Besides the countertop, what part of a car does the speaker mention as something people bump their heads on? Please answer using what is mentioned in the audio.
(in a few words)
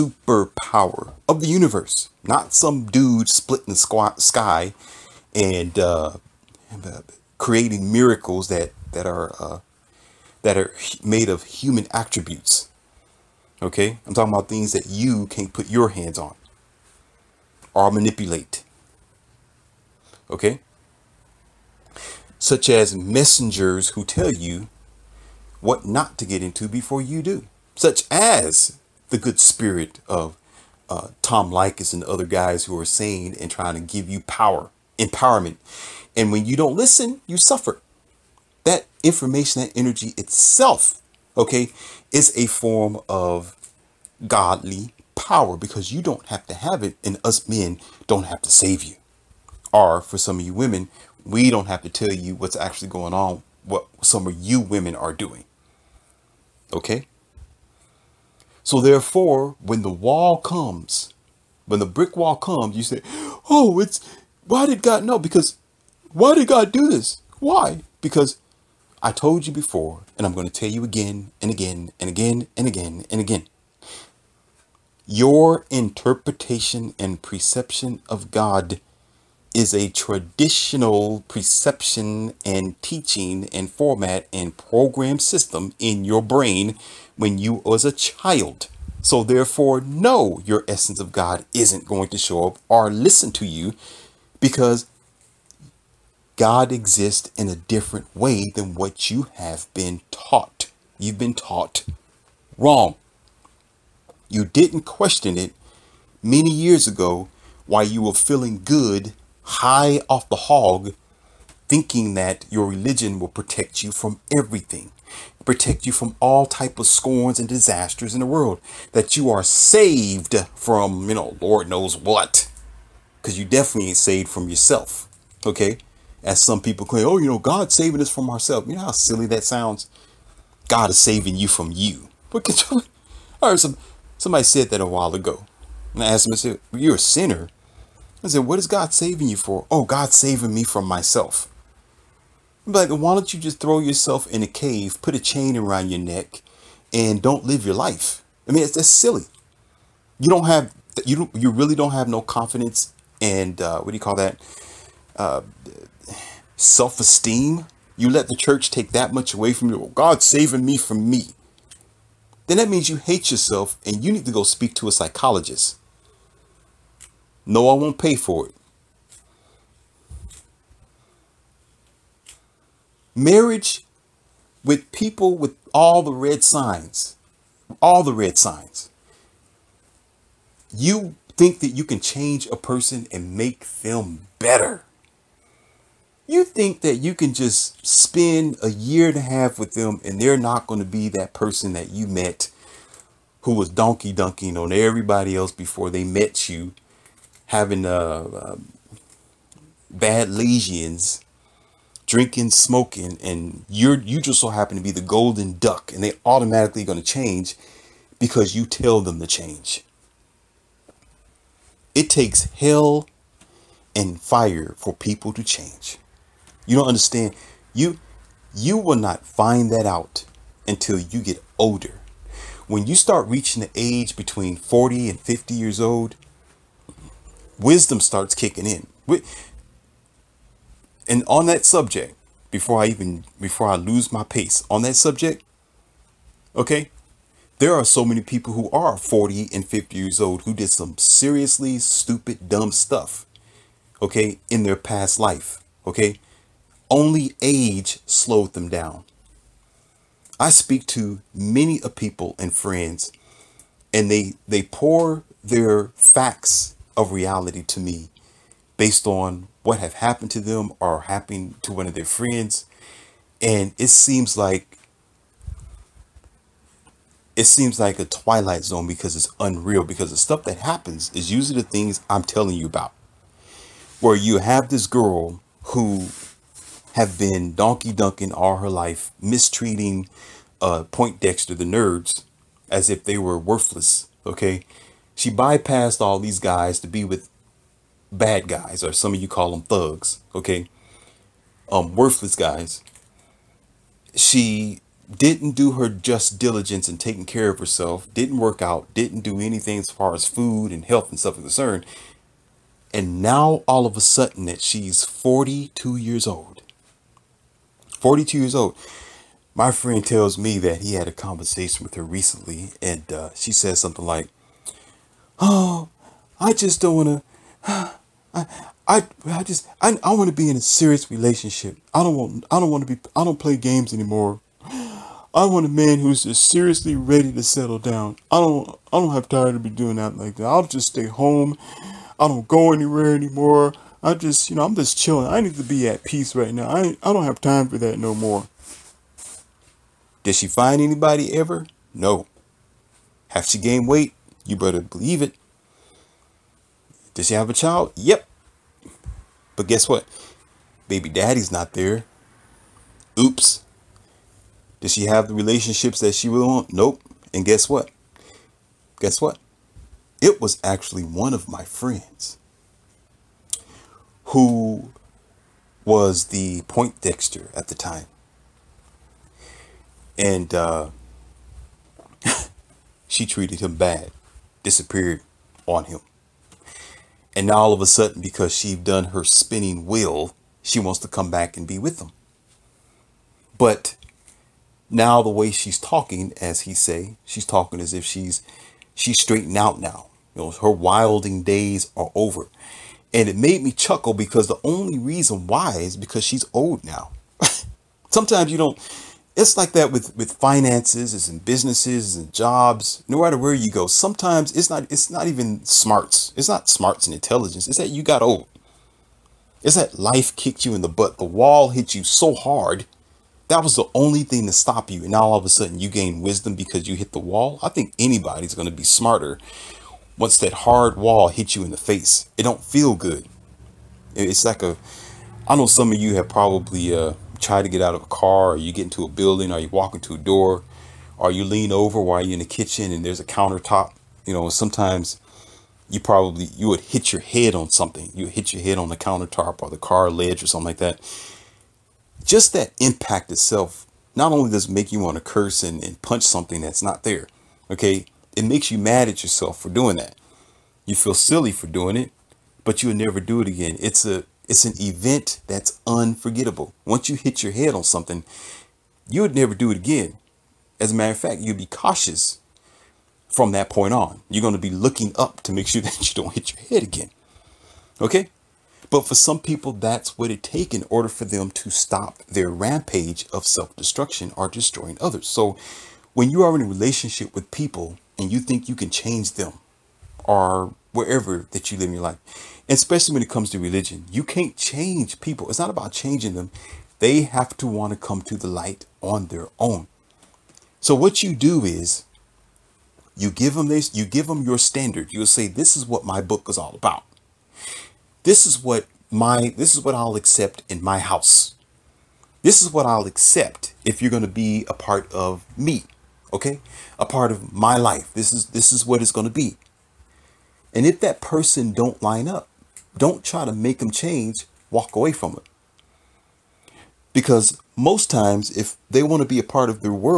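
Car ledge.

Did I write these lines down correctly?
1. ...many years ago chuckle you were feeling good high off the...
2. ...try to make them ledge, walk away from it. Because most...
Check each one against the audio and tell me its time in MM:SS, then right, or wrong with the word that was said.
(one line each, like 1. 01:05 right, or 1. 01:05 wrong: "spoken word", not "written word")
1. 01:46 wrong: "while", not "chuckle"
2. 08:33 wrong: "change", not "ledge".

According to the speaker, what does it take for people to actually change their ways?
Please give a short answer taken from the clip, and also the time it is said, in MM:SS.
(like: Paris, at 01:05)
Hell and fire, at 03:32.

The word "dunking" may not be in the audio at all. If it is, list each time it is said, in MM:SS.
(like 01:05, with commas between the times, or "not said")
03:14, 04:37.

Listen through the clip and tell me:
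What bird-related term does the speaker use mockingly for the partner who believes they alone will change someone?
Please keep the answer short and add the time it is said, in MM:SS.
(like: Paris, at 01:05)
Golden duck, at 03:25.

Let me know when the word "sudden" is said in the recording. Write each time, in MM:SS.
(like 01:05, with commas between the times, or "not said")
05:03, 06:17, 06:55.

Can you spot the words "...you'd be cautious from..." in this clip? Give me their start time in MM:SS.
07:41.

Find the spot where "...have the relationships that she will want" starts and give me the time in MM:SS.
05:55.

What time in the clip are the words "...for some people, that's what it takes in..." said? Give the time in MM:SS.
07:49.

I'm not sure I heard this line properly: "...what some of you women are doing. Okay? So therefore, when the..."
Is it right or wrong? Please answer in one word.
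right.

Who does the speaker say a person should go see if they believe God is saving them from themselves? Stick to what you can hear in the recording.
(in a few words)
A psychologist.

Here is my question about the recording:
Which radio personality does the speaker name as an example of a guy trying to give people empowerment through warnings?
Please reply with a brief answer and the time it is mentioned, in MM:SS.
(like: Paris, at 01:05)
Tom Leykis, at 00:31.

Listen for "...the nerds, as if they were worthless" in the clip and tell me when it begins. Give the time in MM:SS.
04:41.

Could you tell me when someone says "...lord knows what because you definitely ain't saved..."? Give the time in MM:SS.
02:01.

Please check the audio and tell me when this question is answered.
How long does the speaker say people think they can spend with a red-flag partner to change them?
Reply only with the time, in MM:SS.
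03:08.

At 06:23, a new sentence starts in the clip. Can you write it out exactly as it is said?
But now the way she's talking, as he say, she's talking as if she's she's straightened out now.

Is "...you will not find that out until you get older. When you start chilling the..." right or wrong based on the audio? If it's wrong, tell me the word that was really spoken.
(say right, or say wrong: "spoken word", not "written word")
wrong: "reaching", not "chilling".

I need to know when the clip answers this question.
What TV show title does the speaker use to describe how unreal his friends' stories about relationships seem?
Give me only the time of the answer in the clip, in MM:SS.
04:28.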